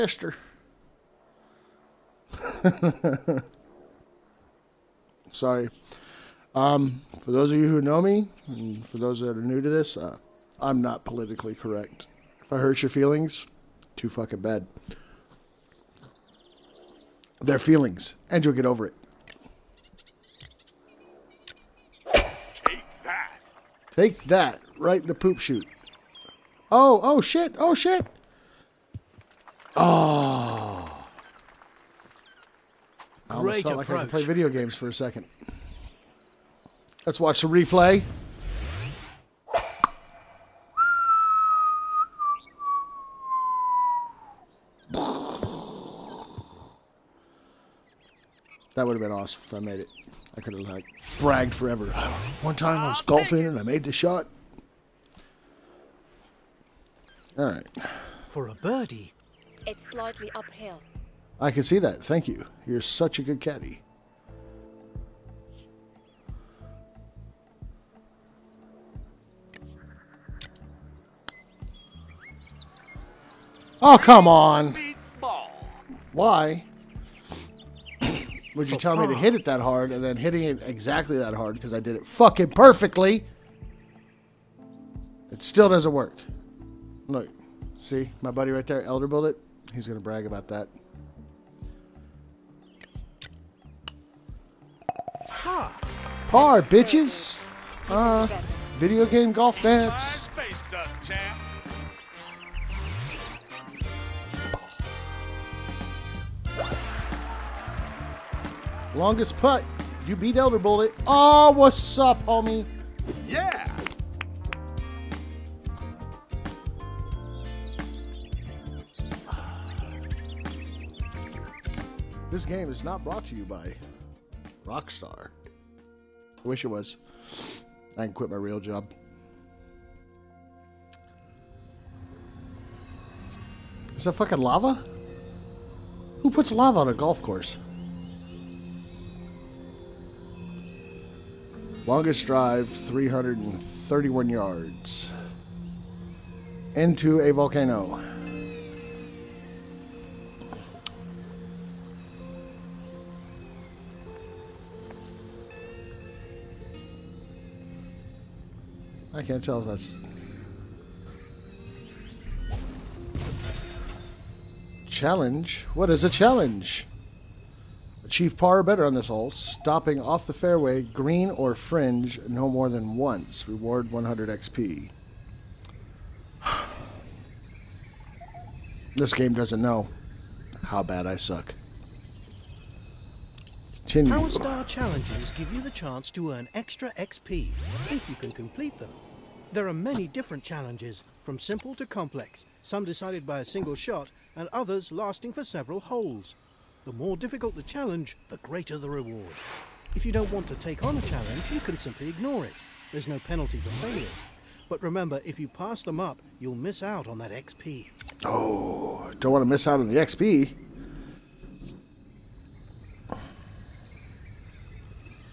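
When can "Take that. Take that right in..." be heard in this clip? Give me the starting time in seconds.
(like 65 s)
22 s.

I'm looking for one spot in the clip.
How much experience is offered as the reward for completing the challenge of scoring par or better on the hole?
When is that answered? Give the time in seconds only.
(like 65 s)
173 s.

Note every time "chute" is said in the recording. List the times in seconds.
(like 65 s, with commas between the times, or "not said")
25 s.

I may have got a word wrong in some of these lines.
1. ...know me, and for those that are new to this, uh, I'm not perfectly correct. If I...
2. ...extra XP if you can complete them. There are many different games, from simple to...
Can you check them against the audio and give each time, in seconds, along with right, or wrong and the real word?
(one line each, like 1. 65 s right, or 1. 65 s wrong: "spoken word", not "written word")
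1. 7 s wrong: "politically", not "perfectly"
2. 186 s wrong: "challenges", not "games".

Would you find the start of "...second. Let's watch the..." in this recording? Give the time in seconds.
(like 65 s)
34 s.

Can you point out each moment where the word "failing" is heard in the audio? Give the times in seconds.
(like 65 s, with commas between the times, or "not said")
203 s.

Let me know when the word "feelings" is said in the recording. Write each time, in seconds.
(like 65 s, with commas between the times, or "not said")
12 s, 17 s.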